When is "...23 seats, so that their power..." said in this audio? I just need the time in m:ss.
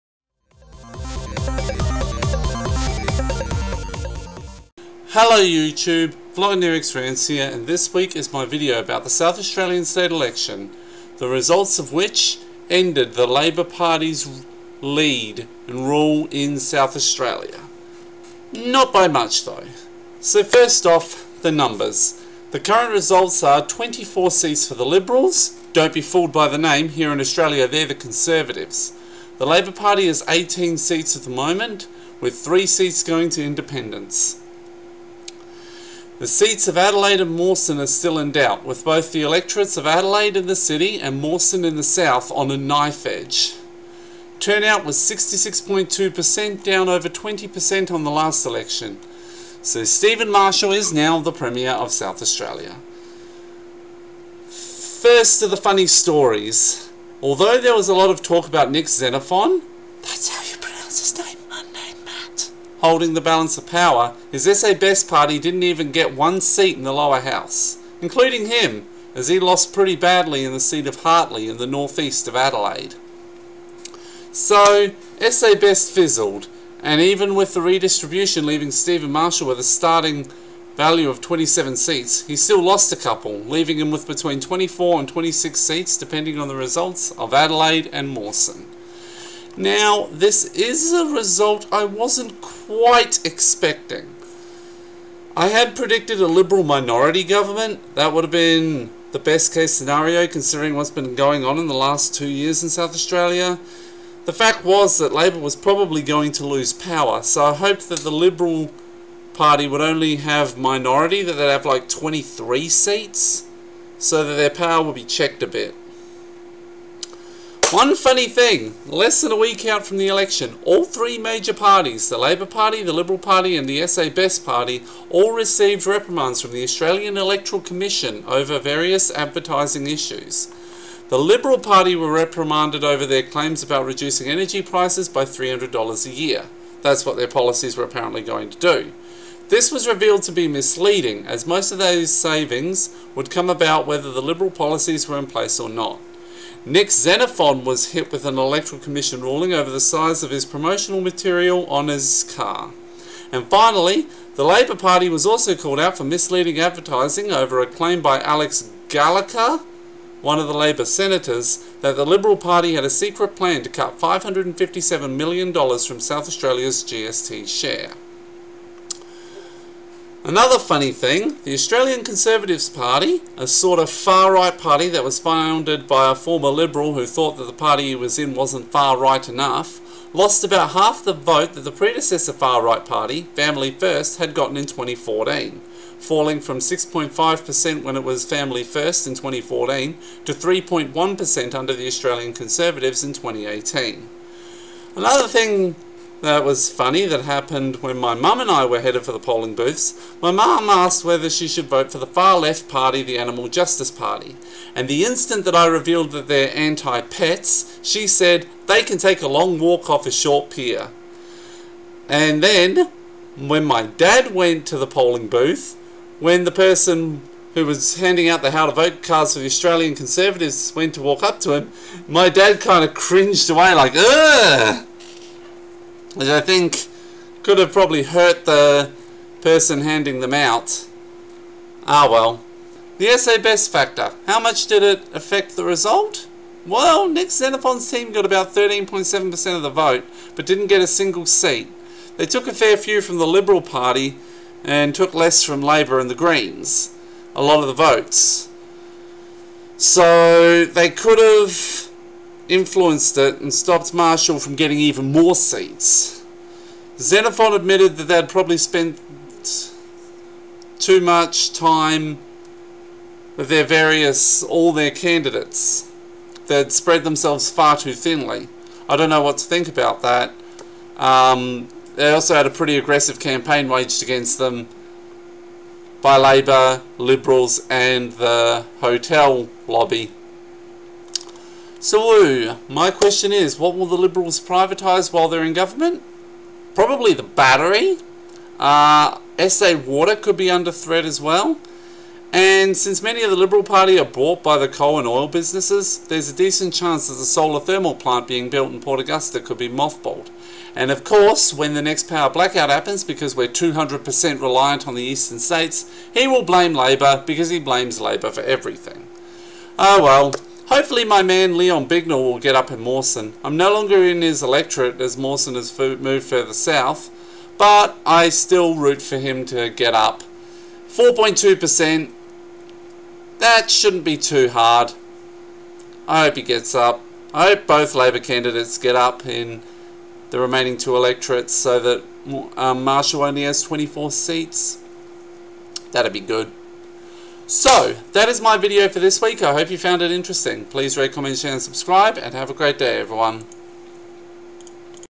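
1:51.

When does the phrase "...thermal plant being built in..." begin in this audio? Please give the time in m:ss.
4:57.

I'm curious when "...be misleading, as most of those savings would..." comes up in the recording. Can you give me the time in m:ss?
2:20.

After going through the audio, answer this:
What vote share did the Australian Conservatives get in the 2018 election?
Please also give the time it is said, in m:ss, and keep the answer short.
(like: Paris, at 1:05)
3.1%, at 3:10.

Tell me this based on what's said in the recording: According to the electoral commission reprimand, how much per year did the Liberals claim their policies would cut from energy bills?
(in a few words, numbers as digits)
$300.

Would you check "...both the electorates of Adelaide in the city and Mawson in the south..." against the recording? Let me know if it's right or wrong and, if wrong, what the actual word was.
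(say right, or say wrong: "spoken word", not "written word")
right.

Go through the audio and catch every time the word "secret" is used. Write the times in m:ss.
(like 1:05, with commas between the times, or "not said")
2:42.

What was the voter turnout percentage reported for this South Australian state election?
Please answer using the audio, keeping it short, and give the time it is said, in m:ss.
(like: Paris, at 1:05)
66.2%, at 0:44.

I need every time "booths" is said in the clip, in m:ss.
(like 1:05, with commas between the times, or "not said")
3:19, 3:35.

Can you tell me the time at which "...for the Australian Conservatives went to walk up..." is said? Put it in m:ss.
3:39.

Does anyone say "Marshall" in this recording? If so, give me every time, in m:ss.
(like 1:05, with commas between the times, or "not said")
0:50, 1:19, 4:13, 5:32.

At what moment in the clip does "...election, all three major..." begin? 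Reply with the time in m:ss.
2:00.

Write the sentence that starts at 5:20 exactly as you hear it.
4.2%, that shouldn't be too hard.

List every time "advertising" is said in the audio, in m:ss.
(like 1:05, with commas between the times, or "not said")
2:09, 2:36.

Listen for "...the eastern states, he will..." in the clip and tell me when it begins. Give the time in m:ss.
5:04.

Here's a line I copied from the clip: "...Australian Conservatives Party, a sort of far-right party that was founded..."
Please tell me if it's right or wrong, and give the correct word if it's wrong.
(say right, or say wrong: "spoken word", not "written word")
right.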